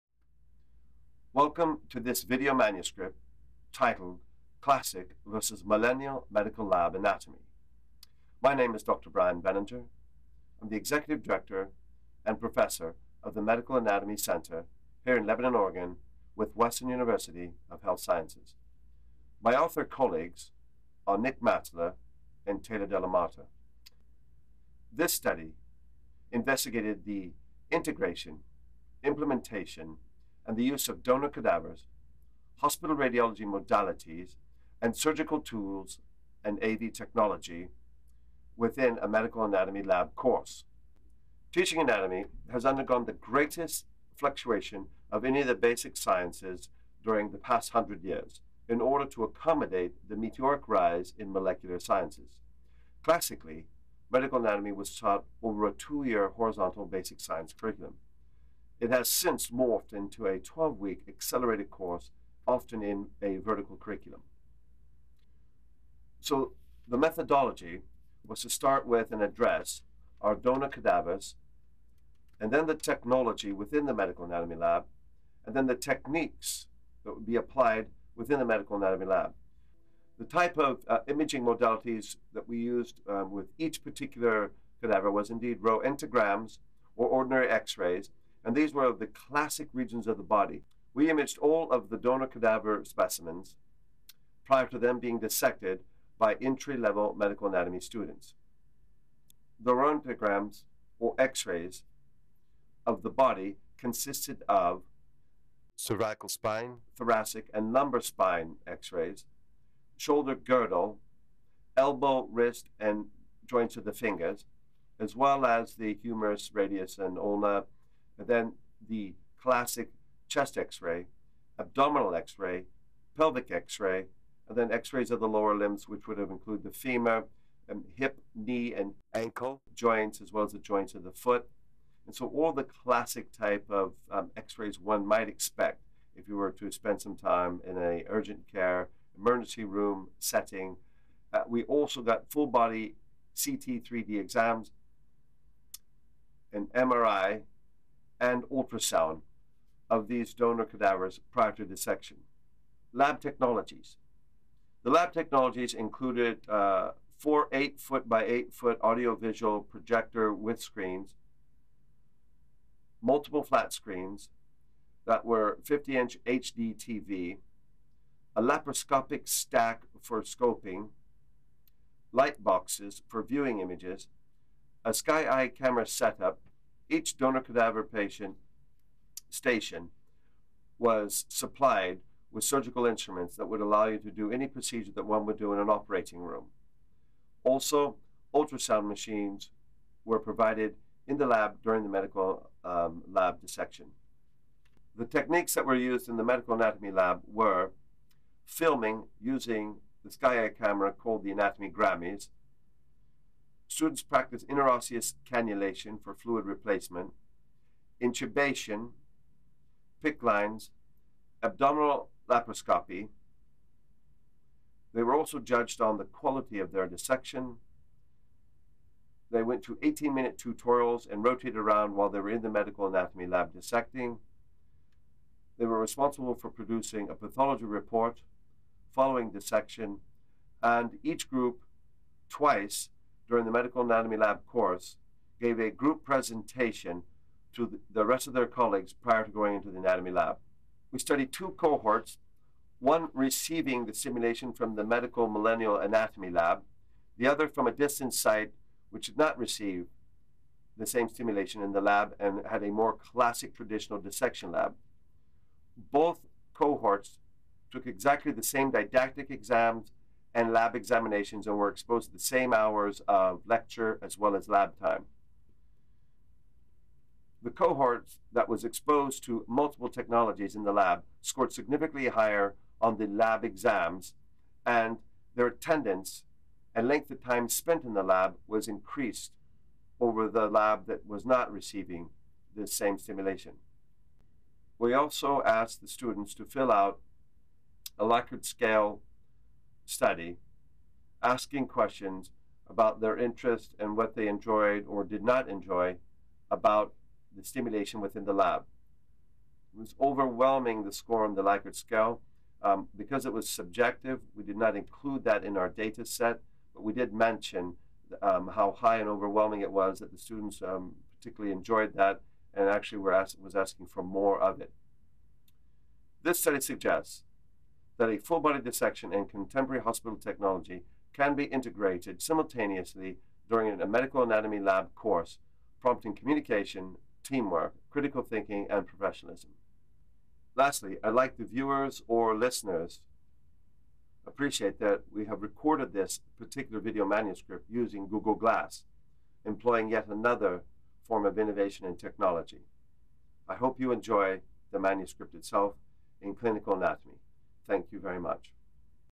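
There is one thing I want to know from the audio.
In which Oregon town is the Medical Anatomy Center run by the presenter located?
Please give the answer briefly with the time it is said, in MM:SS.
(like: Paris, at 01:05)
Lebanon, at 00:15.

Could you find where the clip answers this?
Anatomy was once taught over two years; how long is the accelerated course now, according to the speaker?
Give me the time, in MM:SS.
01:00.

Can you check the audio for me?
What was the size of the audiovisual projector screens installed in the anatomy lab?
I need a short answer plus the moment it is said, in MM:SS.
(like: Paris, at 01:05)
8 foot by 8 foot, at 02:37.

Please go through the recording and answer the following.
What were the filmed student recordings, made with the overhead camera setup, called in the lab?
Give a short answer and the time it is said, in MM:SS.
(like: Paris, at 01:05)
anatomy Grammys, at 03:21.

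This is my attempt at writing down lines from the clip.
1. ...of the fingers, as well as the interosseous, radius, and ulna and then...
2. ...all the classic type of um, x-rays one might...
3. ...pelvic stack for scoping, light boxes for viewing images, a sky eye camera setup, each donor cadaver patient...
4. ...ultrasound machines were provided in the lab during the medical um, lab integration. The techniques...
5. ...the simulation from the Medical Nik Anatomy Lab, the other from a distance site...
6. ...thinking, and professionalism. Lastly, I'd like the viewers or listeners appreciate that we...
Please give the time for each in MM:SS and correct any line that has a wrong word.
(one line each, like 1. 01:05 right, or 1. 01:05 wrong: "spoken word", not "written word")
1. 01:53 wrong: "humerus", not "interosseous"
2. 02:12 right
3. 02:48 wrong: "laparoscopic", not "pelvic"
4. 03:08 wrong: "dissection", not "integration"
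5. 04:03 wrong: "Millennial", not "Nik"
6. 05:28 right.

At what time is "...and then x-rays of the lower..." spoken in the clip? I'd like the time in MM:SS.
02:04.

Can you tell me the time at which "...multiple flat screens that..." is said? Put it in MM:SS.
02:43.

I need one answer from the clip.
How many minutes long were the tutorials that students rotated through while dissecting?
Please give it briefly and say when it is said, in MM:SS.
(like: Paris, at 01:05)
18, at 03:39.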